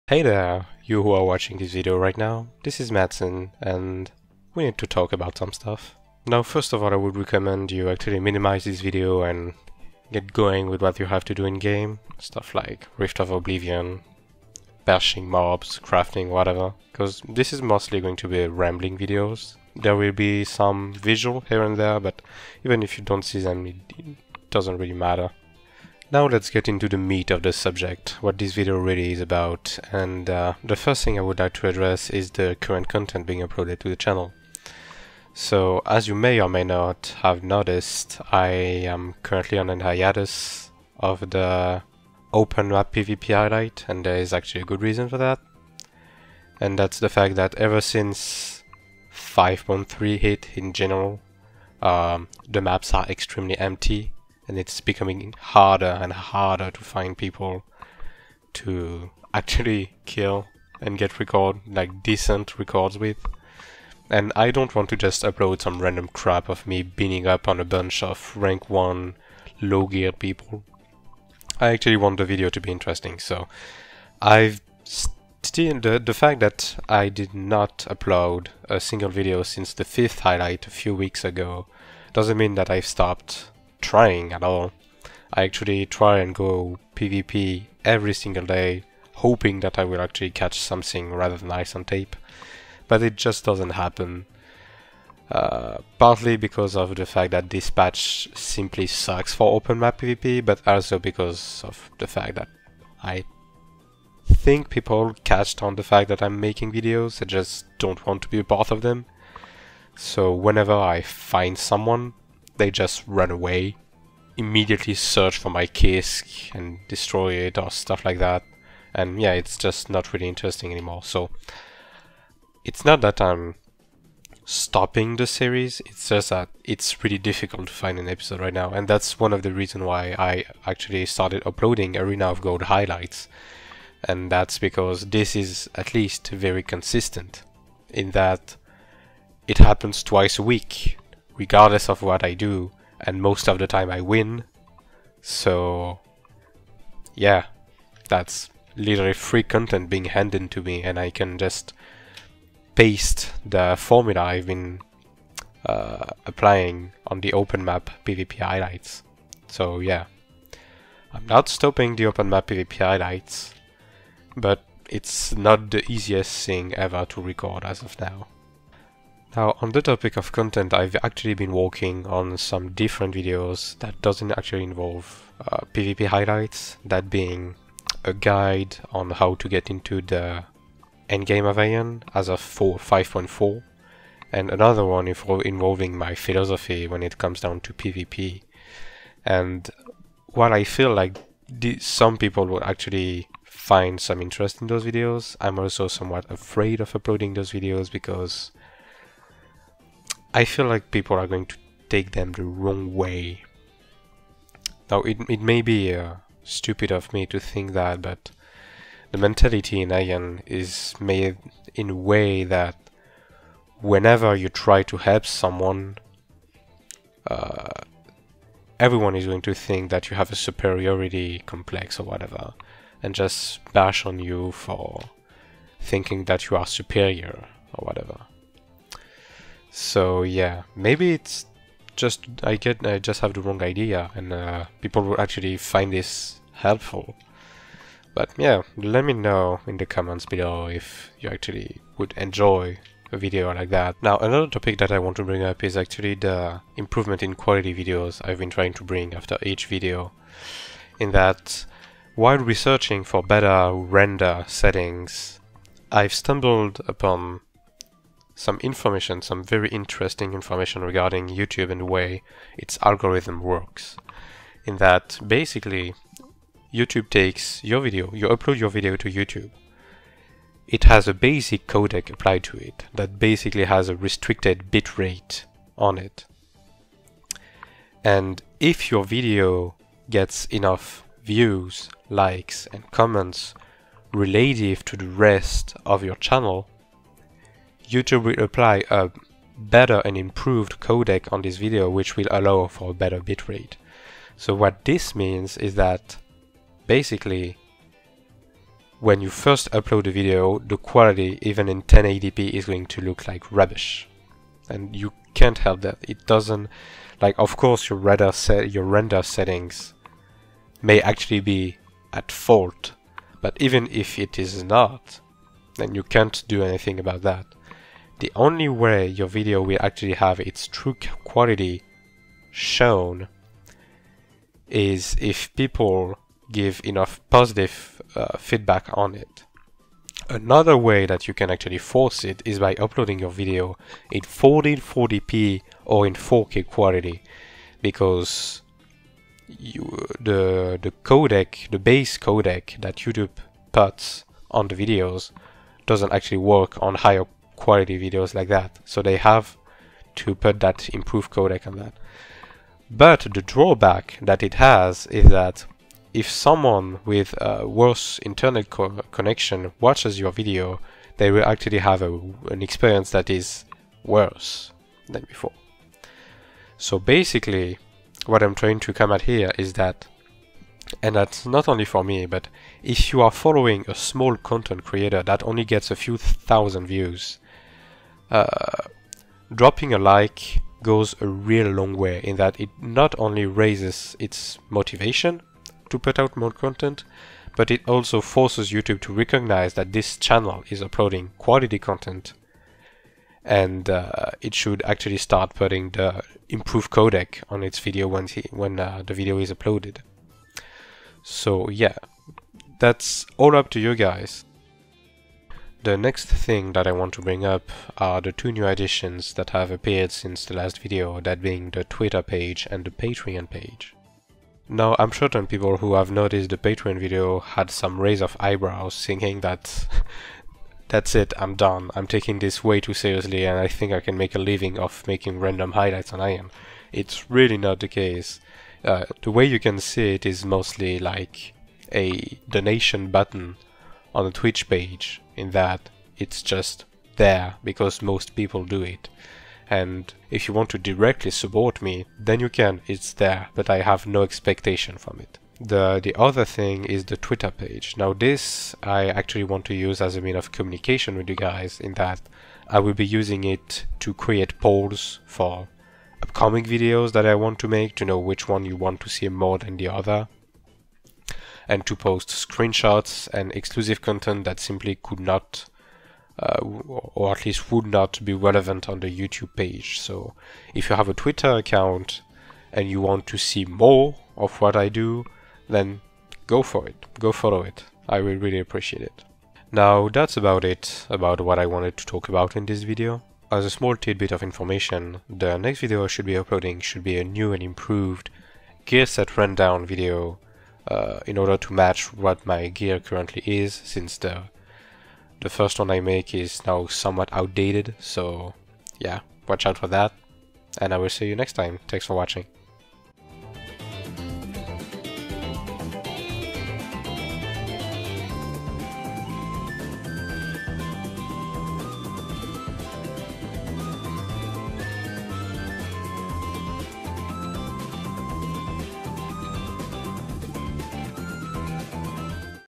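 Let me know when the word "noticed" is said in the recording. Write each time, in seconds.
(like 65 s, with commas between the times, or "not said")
37 s, 416 s.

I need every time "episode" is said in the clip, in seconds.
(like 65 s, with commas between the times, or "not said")
128 s.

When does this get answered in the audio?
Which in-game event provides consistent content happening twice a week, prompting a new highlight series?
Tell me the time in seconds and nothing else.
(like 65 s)
131 s.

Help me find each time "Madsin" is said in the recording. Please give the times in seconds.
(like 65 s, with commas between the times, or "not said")
2 s.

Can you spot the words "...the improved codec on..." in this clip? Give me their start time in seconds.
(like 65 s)
395 s.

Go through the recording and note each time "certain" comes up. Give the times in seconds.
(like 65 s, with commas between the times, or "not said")
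415 s.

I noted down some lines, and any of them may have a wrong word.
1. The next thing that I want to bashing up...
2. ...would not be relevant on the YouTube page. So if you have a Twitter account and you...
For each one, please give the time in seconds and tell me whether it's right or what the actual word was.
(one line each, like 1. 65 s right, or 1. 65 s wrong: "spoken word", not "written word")
1. 405 s wrong: "bring", not "bashing"
2. 467 s right.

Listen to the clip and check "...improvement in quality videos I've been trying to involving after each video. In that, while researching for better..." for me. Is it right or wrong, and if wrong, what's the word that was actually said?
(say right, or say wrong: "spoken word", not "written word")
wrong: "bring", not "involving".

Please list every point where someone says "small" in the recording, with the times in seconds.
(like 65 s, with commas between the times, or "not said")
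373 s, 483 s.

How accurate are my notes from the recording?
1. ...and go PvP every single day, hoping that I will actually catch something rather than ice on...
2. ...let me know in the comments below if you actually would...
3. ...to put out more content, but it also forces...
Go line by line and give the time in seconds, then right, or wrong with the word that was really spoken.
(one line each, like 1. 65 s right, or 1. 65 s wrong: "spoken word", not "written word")
1. 86 s right
2. 238 s right
3. 385 s right.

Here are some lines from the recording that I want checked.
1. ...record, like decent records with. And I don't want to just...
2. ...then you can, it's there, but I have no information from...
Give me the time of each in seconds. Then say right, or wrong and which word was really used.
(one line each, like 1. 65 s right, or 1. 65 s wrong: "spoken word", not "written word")
1. 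61 s right
2. 442 s wrong: "expectation", not "information".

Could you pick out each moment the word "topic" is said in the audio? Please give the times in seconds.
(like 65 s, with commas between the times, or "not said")
169 s, 244 s.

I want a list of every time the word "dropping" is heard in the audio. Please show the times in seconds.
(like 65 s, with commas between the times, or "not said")
379 s.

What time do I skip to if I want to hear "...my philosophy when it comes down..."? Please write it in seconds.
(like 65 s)
185 s.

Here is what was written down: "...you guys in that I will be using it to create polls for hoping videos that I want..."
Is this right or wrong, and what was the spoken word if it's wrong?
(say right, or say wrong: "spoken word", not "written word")
wrong: "upcoming", not "hoping".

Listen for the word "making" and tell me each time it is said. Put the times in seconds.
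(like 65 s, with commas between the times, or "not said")
106 s, 425 s.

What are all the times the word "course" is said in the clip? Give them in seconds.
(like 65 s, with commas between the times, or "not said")
307 s.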